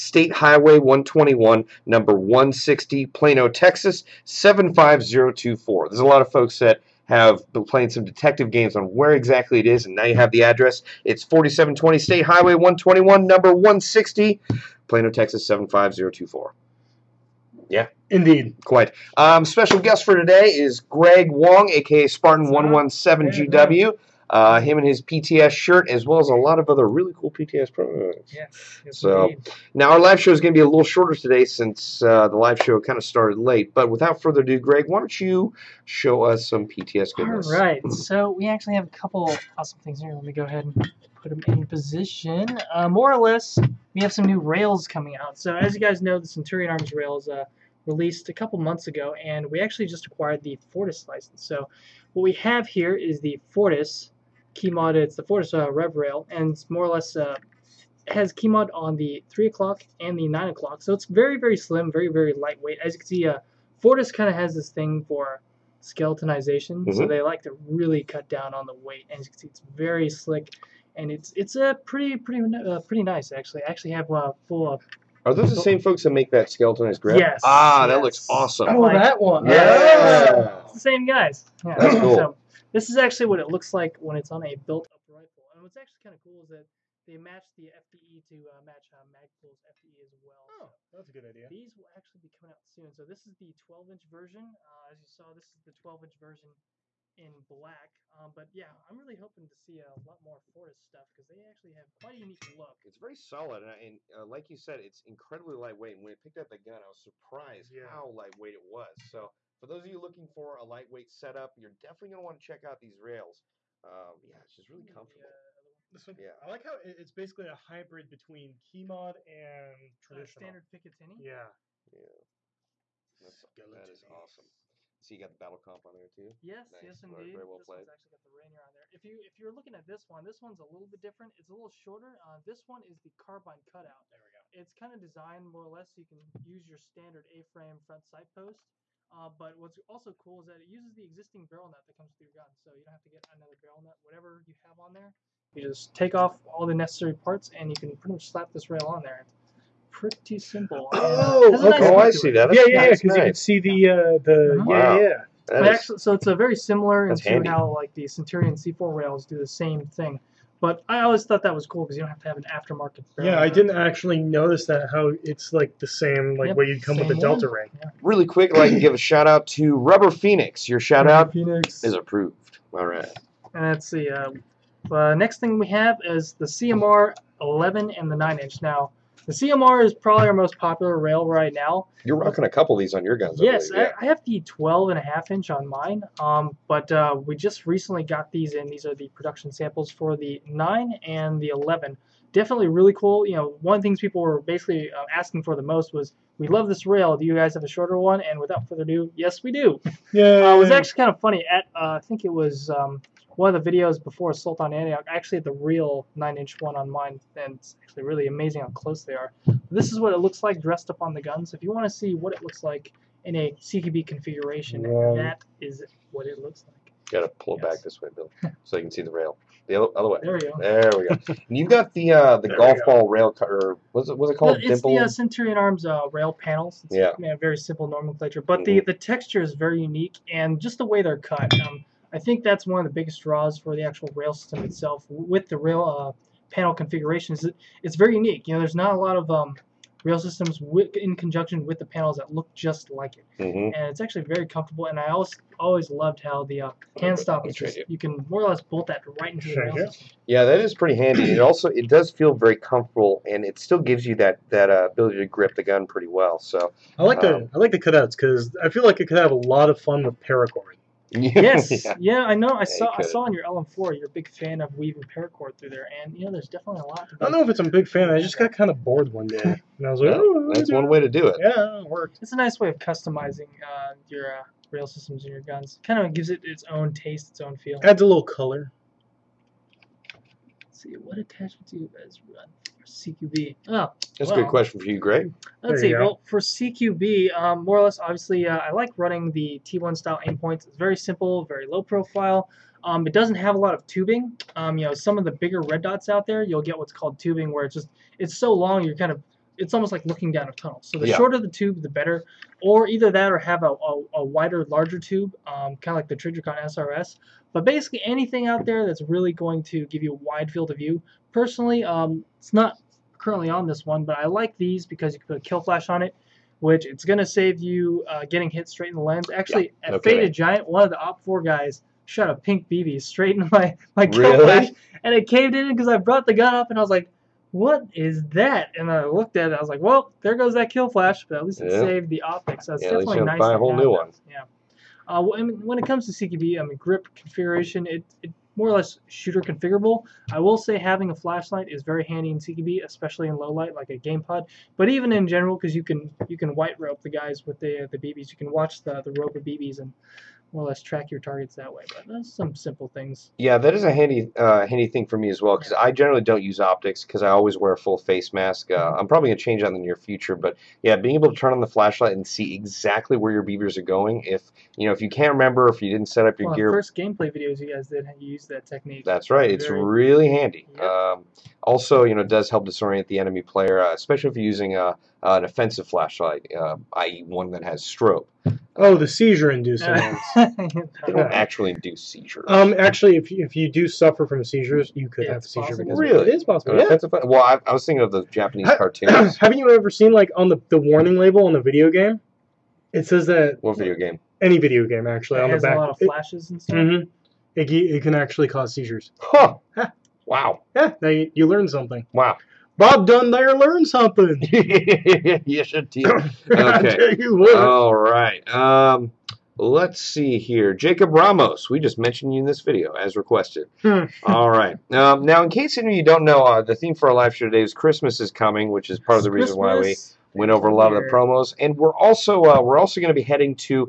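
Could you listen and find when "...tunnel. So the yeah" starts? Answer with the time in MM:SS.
05:00.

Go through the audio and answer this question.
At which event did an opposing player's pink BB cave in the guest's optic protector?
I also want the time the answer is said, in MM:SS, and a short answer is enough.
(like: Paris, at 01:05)
Faded Giant, at 05:20.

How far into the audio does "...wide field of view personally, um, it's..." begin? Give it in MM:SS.
05:10.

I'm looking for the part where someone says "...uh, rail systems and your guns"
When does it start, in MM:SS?
04:34.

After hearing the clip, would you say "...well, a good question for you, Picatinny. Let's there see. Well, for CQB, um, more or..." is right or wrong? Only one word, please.
wrong.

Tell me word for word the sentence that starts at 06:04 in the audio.
If you know if you can't remember if you didn't set up your well, gear.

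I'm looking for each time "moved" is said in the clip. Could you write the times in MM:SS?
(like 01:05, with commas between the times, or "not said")
not said.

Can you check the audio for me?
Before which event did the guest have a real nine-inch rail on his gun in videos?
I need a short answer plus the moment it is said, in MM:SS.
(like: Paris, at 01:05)
Assault on Antioch, at 03:24.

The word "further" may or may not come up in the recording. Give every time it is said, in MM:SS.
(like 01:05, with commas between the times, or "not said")
00:34, 03:18.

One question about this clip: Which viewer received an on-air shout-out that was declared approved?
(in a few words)
Rubber Phoenix.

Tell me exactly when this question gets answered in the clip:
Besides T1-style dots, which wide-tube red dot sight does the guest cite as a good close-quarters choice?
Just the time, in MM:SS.
05:06.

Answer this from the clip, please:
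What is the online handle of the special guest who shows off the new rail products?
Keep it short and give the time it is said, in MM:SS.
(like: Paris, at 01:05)
Spartan117GW, at 00:22.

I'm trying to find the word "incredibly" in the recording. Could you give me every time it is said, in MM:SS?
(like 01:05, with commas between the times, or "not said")
01:45.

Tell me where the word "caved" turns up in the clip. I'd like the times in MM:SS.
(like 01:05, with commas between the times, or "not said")
05:25.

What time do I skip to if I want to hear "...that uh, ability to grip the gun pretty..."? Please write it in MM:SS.
04:14.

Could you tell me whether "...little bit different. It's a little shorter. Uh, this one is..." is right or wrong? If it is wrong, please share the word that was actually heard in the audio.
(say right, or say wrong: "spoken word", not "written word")
right.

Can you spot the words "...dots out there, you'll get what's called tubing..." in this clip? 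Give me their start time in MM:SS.
04:55.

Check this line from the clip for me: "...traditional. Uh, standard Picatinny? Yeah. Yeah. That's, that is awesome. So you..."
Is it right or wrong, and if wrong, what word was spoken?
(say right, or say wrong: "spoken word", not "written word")
right.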